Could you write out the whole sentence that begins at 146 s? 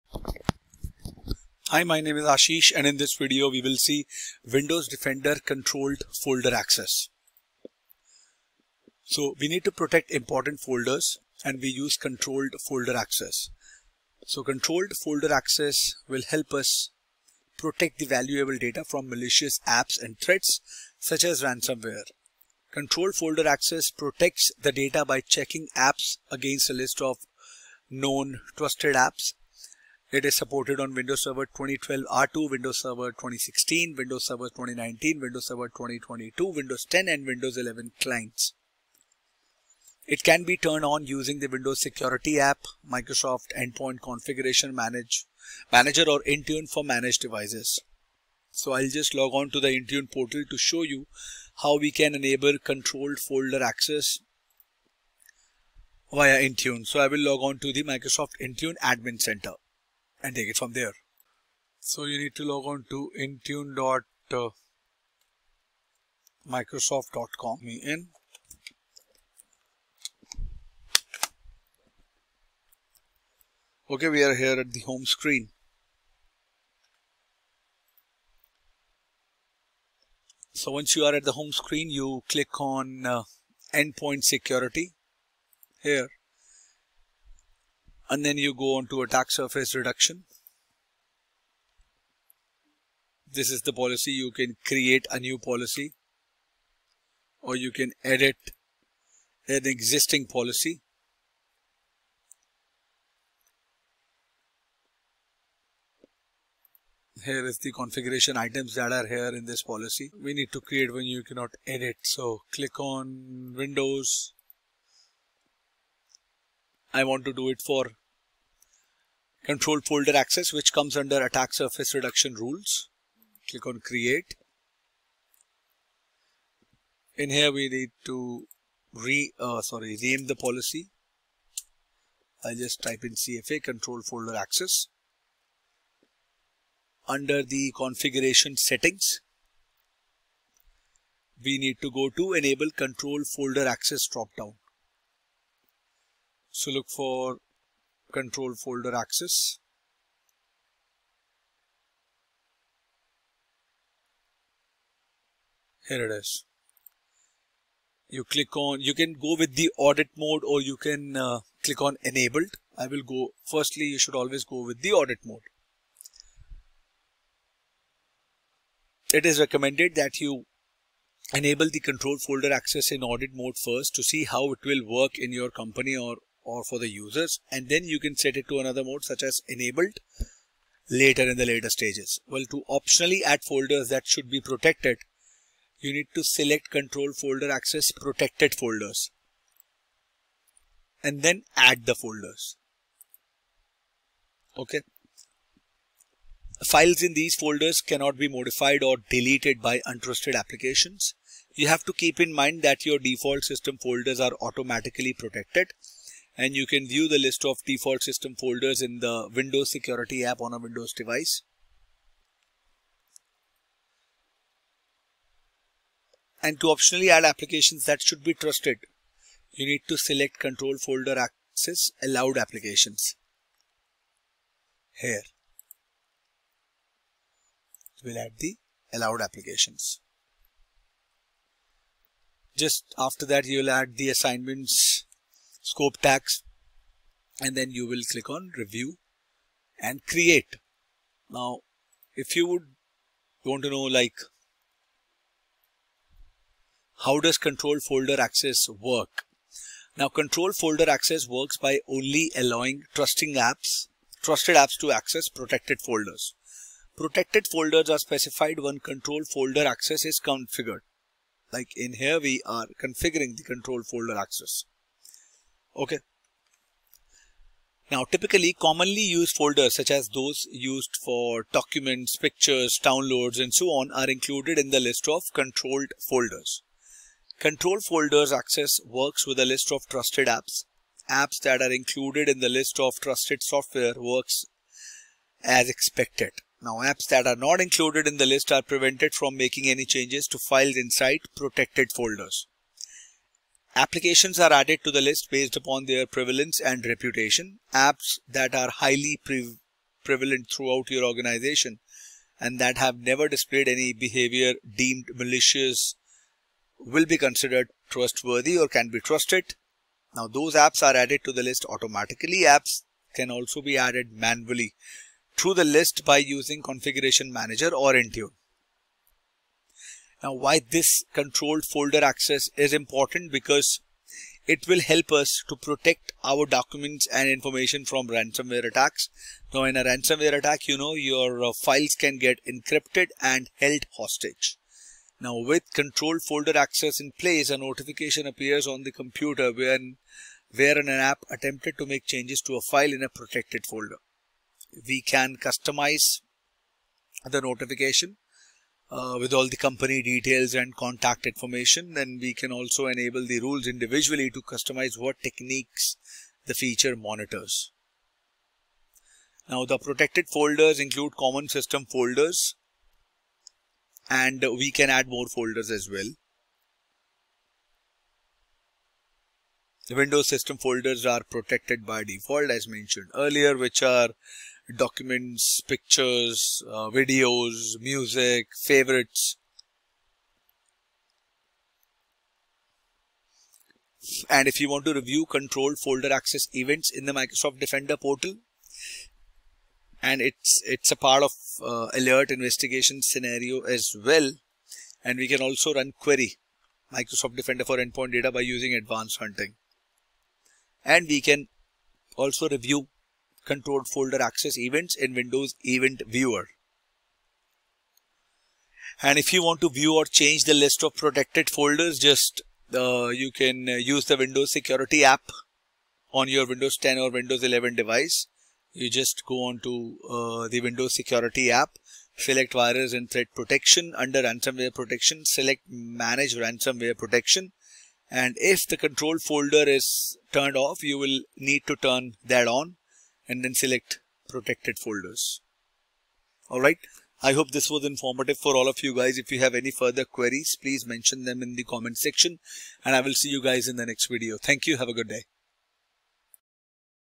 So look for control folder access.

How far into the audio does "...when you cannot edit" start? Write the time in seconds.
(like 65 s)
110 s.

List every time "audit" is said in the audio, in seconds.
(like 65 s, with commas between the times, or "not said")
159 s, 164 s, 173 s.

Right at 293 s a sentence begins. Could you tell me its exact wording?
Applications are added to the list based upon their prevalence and reputation.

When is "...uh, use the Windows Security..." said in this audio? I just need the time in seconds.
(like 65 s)
413 s.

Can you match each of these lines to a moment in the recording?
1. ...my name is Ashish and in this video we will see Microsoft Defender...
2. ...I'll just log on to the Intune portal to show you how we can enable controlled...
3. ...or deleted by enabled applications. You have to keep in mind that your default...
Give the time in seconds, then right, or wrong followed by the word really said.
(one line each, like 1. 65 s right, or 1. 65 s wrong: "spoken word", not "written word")
1. 1 s wrong: "Windows", not "Microsoft"
2. 48 s right
3. 198 s wrong: "untrusted", not "enabled".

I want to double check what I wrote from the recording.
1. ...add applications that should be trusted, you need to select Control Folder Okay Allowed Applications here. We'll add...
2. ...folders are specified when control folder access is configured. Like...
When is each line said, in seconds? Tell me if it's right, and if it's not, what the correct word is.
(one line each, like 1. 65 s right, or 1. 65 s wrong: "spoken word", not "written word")
1. 217 s wrong: "Access", not "Okay"
2. 257 s right.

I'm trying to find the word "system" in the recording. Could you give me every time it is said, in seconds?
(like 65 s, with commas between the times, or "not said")
203 s, 208 s, 361 s, 370 s.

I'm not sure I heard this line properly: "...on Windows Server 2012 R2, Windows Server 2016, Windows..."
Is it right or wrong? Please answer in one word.
right.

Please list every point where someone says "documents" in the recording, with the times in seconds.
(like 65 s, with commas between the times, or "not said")
271 s, 326 s, 374 s.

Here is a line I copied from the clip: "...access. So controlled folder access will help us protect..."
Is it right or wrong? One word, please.
right.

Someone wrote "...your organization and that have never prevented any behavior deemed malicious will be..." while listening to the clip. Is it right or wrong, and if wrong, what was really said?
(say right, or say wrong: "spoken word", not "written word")
wrong: "displayed", not "prevented".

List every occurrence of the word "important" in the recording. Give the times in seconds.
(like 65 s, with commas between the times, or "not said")
10 s, 322 s.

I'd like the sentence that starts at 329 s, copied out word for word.
Now in a ransomware attack, you know, your uh, files can get encrypted and held hostage.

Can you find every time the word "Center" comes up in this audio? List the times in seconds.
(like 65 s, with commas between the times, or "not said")
59 s.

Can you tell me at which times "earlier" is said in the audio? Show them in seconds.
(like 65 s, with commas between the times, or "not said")
373 s.